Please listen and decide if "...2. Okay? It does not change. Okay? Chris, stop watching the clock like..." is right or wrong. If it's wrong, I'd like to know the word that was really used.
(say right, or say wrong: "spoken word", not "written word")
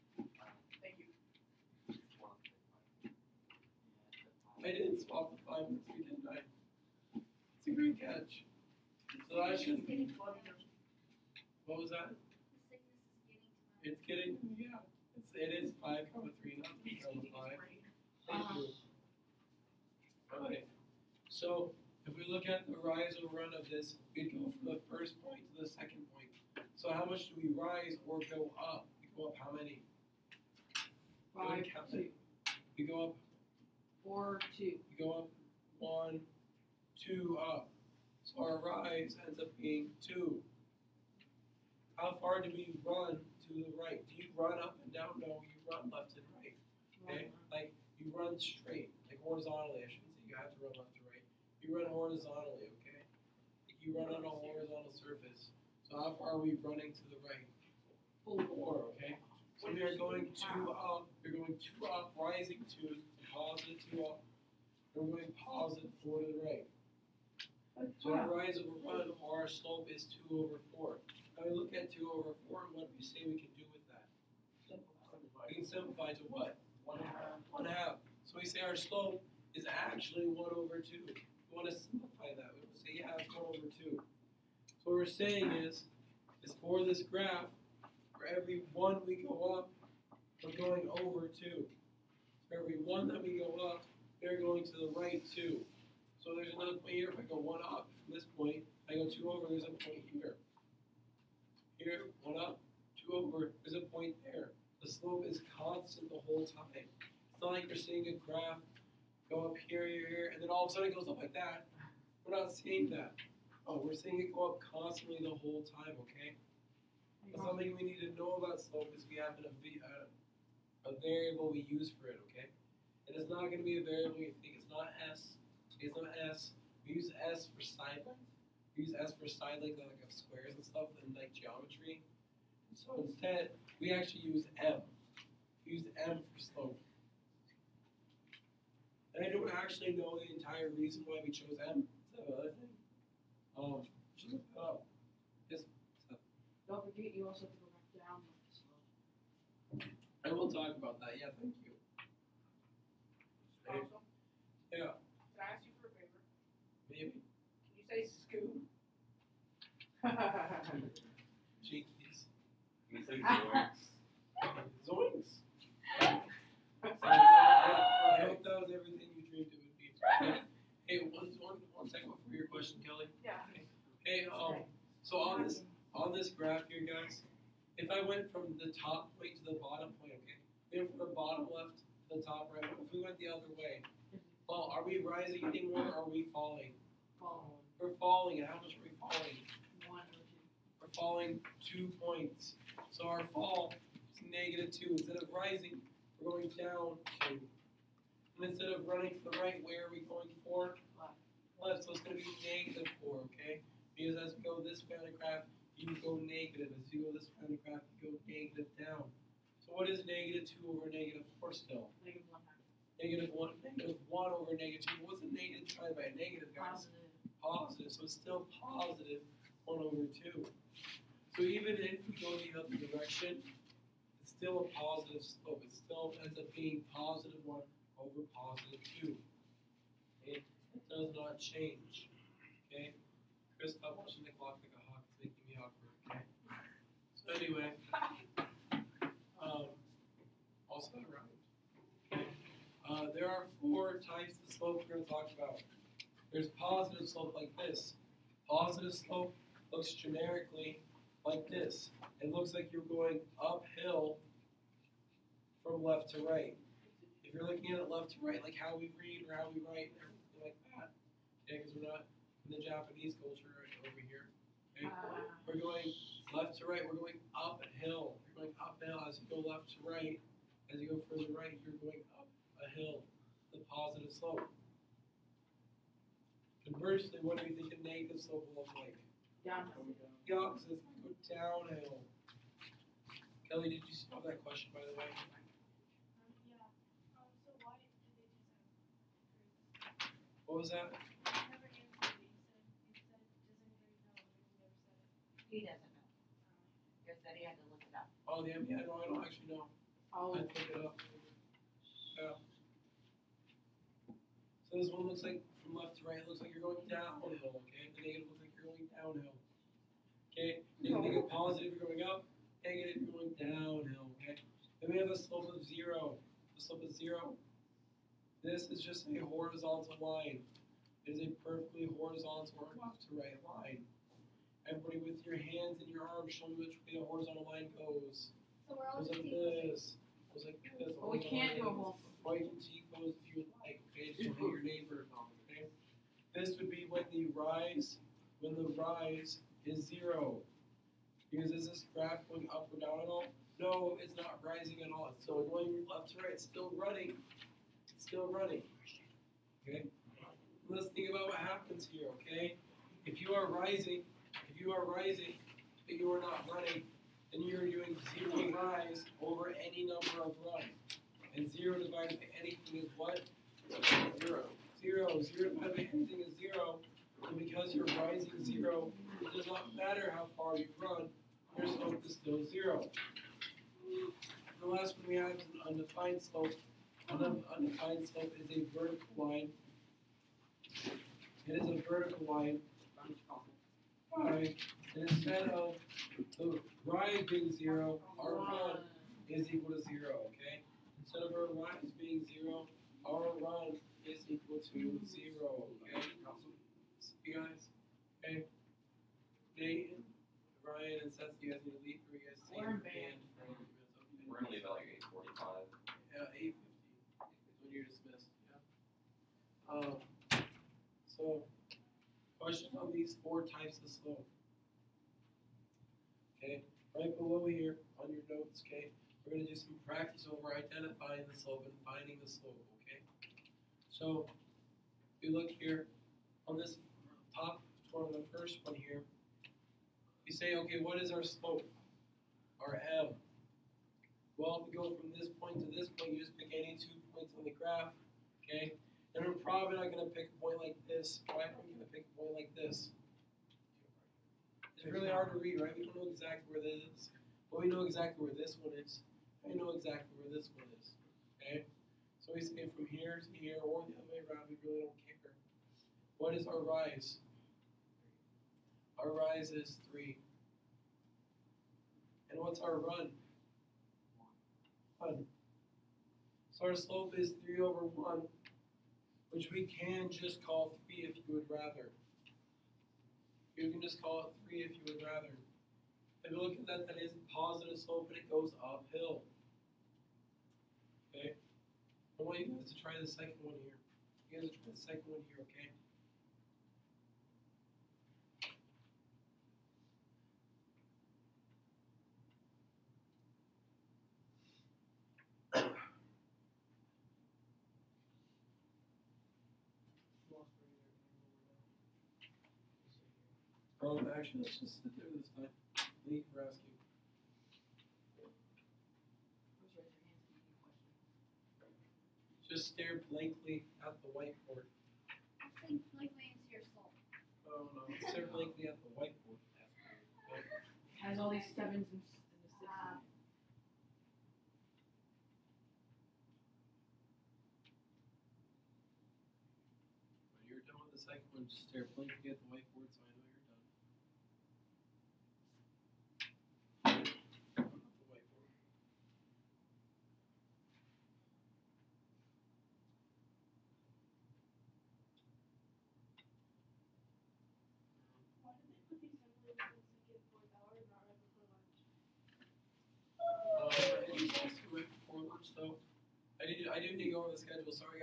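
right.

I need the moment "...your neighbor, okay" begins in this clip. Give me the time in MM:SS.
05:34.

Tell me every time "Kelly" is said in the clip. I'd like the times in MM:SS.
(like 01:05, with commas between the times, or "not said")
02:52, 04:43.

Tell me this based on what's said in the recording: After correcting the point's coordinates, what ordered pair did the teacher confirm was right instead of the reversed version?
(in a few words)
5, 3.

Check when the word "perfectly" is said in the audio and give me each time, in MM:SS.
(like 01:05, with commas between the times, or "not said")
05:21.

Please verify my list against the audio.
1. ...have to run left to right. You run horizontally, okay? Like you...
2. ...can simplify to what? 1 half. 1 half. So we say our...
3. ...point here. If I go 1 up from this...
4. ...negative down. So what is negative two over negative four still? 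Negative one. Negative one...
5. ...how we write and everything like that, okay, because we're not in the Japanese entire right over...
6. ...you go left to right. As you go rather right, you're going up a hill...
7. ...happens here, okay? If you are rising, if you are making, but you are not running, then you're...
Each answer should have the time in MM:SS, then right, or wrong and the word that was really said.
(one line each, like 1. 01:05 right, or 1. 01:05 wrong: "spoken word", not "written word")
1. 00:50 right
2. 01:15 right
3. 01:36 right
4. 03:28 right
5. 04:19 wrong: "culture", not "entire"
6. 04:29 wrong: "further", not "rather"
7. 05:51 wrong: "rising", not "making".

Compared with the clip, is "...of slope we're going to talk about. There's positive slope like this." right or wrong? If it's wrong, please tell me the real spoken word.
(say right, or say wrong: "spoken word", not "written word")
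right.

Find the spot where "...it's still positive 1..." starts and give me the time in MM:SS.
03:38.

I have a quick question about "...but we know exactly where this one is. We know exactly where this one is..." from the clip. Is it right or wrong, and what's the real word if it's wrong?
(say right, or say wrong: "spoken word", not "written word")
right.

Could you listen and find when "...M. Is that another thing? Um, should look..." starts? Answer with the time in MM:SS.
02:21.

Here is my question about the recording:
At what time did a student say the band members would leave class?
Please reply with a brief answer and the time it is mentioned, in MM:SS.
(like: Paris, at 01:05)
8:45, at 06:44.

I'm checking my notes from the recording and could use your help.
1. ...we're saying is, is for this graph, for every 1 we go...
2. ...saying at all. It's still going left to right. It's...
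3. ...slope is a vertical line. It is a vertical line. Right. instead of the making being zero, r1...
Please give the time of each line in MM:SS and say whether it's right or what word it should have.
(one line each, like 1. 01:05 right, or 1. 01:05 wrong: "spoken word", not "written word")
1. 01:24 right
2. 05:44 wrong: "rising", not "saying"
3. 06:18 wrong: "rising", not "making".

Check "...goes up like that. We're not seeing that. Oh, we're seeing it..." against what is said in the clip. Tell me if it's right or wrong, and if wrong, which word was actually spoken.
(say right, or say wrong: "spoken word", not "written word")
right.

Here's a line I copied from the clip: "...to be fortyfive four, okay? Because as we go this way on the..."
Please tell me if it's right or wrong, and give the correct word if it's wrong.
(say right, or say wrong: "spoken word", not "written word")
wrong: "negative", not "fortyfive".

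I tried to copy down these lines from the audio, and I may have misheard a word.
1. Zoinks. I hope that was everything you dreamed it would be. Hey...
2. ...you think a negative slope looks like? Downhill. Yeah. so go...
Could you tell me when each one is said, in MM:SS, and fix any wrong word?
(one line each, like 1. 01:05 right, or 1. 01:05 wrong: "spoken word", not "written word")
1. 02:42 right
2. 04:37 right.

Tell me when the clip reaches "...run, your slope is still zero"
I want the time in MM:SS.
06:10.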